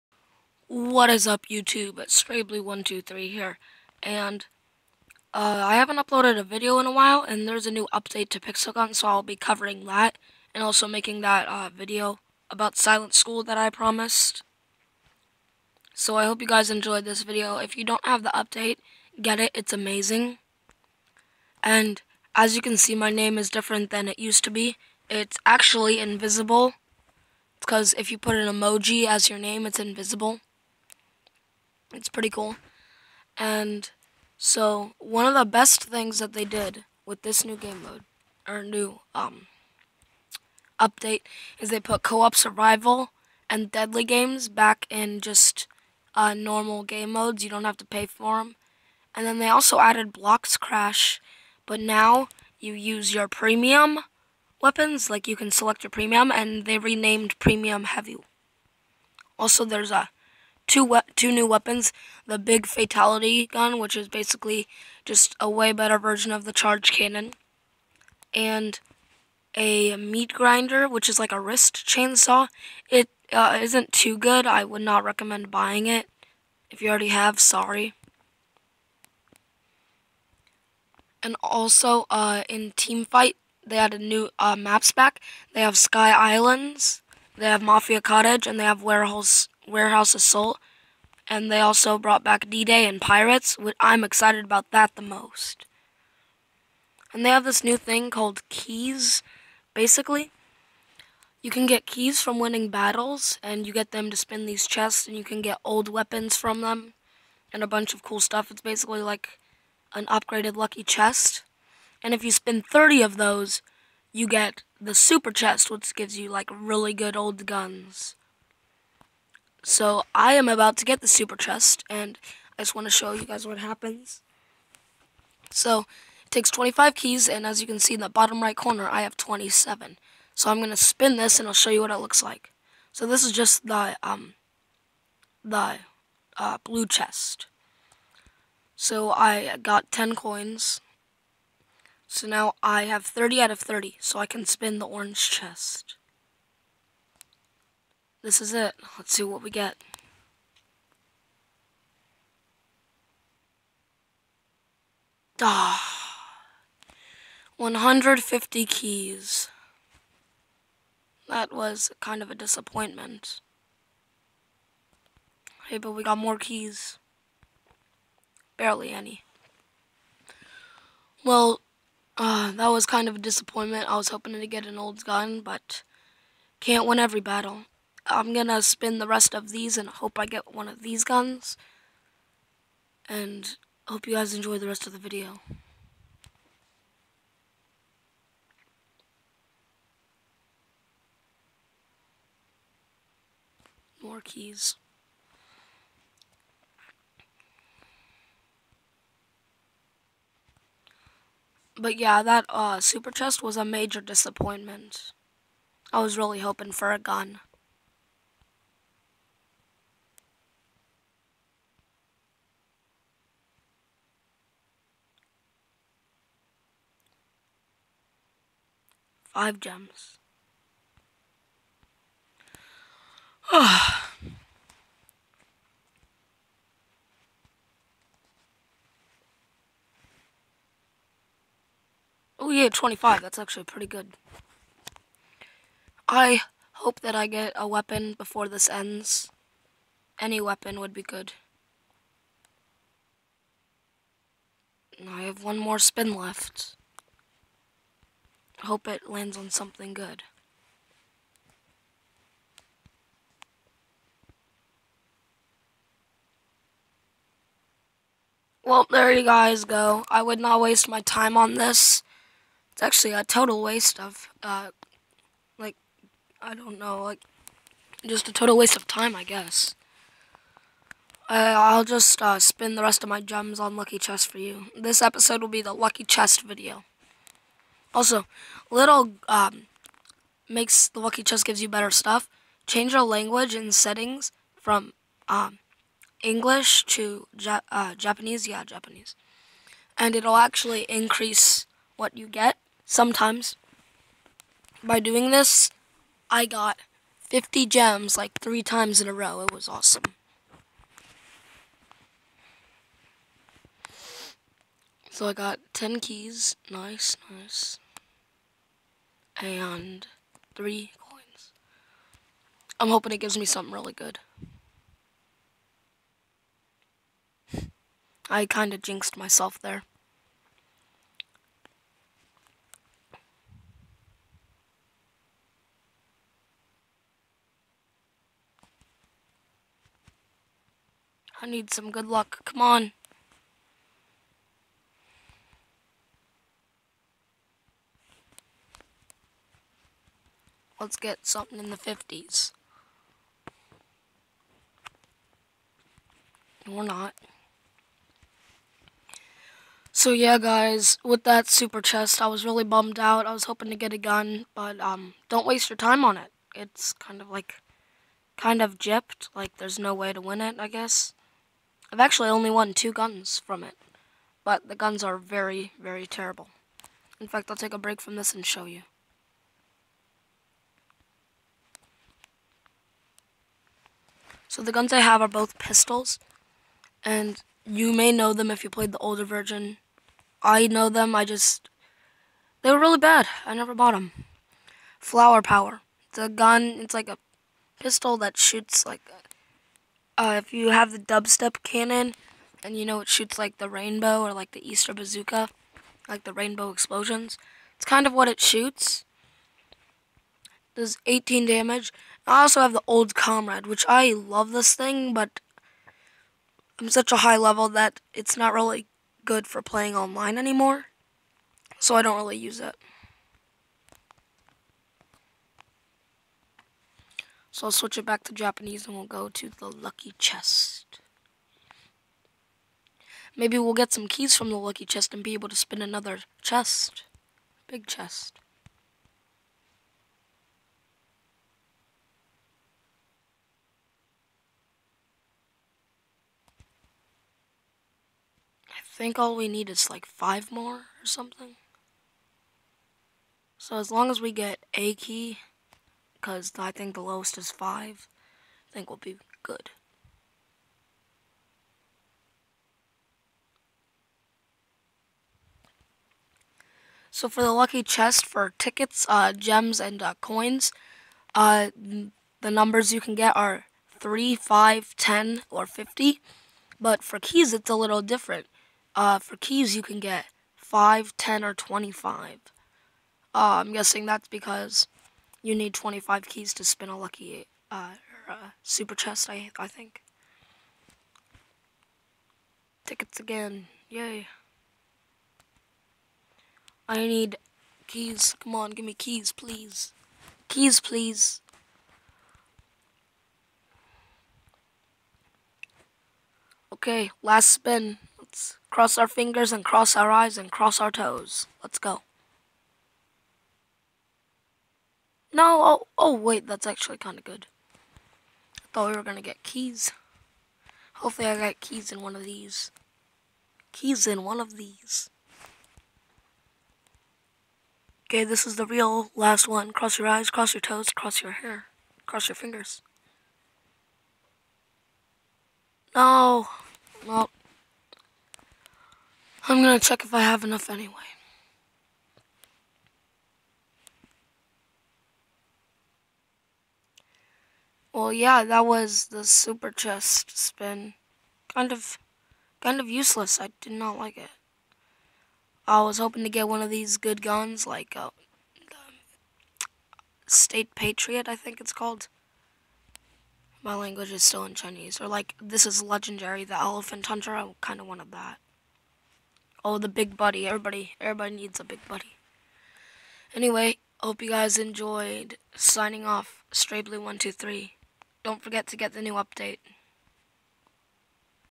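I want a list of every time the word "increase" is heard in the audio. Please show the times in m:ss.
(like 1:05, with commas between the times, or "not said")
4:50.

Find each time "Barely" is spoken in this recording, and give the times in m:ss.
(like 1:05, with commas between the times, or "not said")
2:48.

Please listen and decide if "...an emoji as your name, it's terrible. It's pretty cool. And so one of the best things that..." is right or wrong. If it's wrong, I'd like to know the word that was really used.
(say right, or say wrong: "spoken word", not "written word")
wrong: "invisible", not "terrible".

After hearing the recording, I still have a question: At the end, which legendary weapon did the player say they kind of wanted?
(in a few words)
Elephant Hunter.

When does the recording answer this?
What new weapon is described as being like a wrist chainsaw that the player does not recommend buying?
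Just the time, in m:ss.
1:09.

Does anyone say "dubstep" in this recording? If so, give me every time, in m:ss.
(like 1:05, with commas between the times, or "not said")
6:30.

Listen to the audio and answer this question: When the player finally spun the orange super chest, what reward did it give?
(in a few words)
150 keys.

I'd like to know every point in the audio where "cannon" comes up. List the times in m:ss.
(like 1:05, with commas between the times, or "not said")
1:06, 6:31.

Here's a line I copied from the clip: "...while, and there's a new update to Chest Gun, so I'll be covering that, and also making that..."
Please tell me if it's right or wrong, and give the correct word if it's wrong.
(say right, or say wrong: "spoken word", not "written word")
wrong: "Pixel", not "Chest".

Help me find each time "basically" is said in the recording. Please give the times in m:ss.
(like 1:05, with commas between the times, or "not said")
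1:04, 1:39, 1:48.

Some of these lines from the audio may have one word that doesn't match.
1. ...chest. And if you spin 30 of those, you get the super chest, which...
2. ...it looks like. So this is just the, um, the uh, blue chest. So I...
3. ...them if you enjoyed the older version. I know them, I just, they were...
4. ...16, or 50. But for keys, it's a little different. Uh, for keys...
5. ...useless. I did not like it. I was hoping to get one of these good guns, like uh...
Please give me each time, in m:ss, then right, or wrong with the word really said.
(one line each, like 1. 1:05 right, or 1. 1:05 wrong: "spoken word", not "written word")
1. 1:50 right
2. 2:11 right
3. 6:18 wrong: "played", not "enjoyed"
4. 7:44 wrong: "10", not "16"
5. 9:02 right.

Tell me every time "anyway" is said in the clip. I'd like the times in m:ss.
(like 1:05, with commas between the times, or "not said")
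8:50, 9:23.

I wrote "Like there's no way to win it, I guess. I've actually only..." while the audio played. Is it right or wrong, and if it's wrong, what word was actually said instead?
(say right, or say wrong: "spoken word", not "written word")
right.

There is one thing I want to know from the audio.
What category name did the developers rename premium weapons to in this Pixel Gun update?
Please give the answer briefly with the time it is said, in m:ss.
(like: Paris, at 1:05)
heavy, at 0:57.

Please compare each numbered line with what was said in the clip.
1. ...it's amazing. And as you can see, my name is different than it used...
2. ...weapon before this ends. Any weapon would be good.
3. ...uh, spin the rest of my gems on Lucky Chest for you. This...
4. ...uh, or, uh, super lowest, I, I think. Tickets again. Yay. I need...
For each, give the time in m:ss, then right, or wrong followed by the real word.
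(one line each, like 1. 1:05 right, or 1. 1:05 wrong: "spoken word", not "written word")
1. 0:19 right
2. 3:57 right
3. 4:32 right
4. 7:57 wrong: "chest", not "lowest".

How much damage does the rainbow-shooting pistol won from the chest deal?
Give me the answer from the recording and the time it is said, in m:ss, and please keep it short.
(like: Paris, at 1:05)
18, at 6:41.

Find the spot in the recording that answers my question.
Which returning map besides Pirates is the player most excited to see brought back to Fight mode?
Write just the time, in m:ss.
1:32.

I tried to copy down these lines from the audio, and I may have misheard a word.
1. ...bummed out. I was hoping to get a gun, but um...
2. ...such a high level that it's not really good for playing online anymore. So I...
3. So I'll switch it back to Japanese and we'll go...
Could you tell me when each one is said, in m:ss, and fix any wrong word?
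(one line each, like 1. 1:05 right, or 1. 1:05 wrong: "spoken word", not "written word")
1. 5:52 right
2. 6:46 right
3. 6:57 right.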